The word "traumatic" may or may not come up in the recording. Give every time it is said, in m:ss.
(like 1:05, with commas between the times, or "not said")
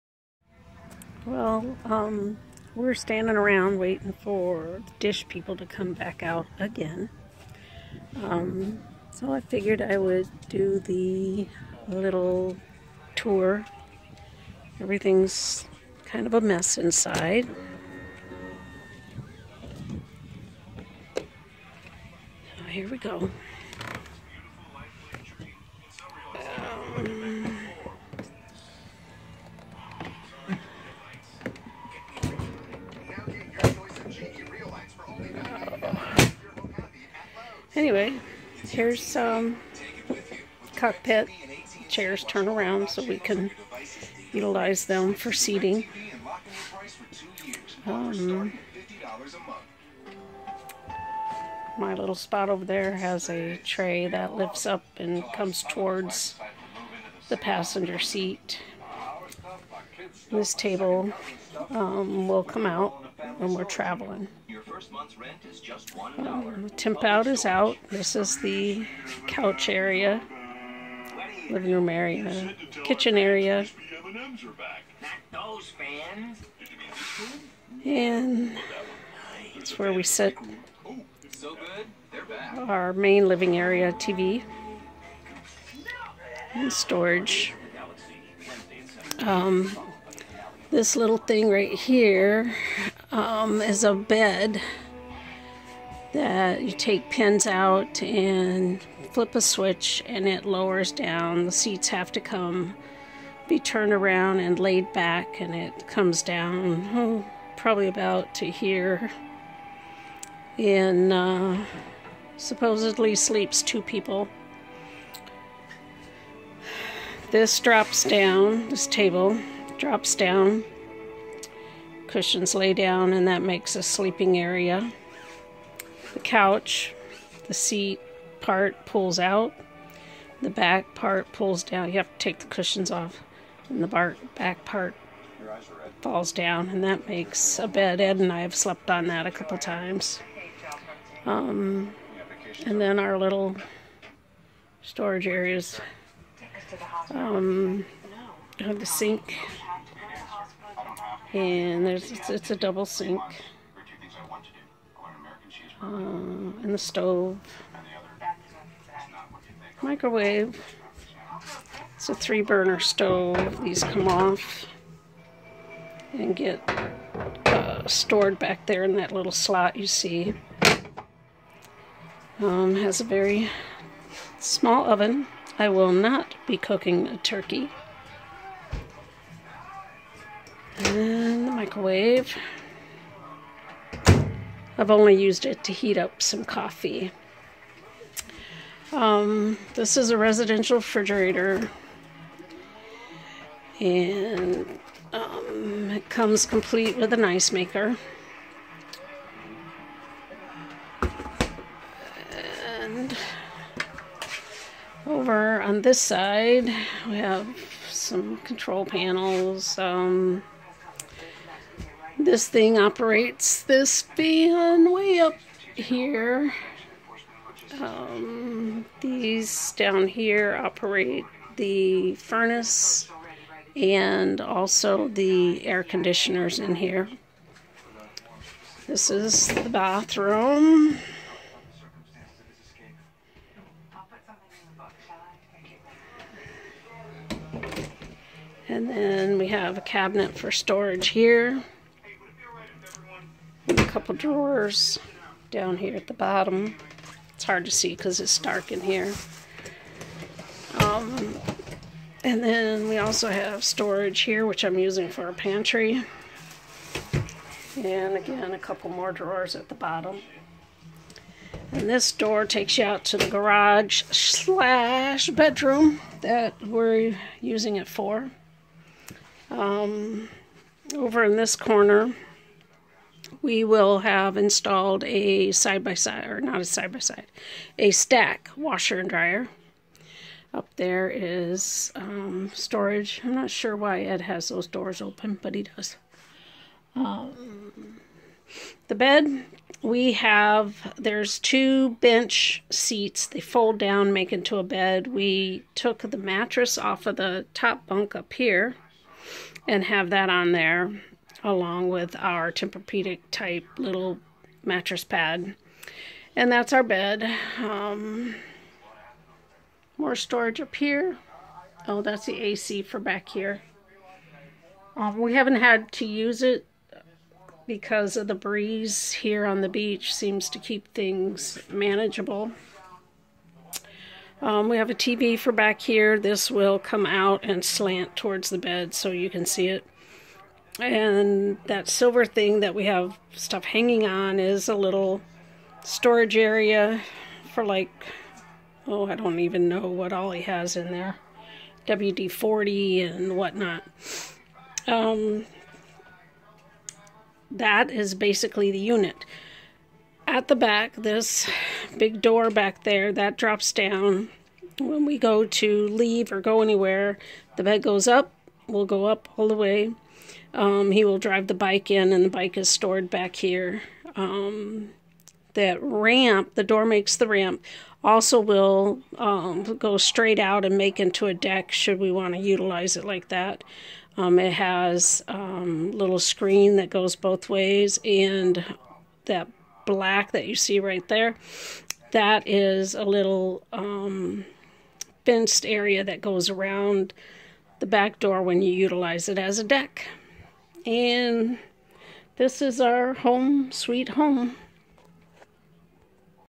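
not said.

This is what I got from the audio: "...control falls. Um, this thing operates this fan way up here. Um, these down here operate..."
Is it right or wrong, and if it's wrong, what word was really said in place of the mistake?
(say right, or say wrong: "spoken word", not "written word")
wrong: "panels", not "falls".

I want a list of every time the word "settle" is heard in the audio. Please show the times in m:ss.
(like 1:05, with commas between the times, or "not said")
not said.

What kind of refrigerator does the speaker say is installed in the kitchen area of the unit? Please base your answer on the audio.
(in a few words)
Residential.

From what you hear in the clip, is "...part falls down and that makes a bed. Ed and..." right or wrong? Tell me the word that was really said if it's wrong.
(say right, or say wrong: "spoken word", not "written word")
right.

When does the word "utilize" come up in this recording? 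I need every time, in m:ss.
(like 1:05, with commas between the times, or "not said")
0:44, 6:12, 6:28.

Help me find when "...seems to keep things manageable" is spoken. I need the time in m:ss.
5:20.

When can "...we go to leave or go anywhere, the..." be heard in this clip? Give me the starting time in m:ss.
5:55.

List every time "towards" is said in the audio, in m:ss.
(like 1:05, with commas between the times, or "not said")
0:55, 5:28.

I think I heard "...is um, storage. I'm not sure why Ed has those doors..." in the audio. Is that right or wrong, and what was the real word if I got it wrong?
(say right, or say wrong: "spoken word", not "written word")
right.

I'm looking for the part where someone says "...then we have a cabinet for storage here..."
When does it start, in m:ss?
3:58.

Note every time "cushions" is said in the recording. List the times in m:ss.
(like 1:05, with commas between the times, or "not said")
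2:02, 2:12.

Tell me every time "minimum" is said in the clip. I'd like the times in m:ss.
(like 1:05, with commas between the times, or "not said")
not said.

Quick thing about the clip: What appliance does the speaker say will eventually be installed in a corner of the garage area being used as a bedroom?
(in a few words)
Stack washer and dryer.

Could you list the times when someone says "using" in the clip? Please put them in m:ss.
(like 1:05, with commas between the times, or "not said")
4:14, 4:27.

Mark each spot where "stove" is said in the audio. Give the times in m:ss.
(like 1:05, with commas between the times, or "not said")
2:36, 2:42.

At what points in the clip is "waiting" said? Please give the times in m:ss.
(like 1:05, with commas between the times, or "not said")
0:03.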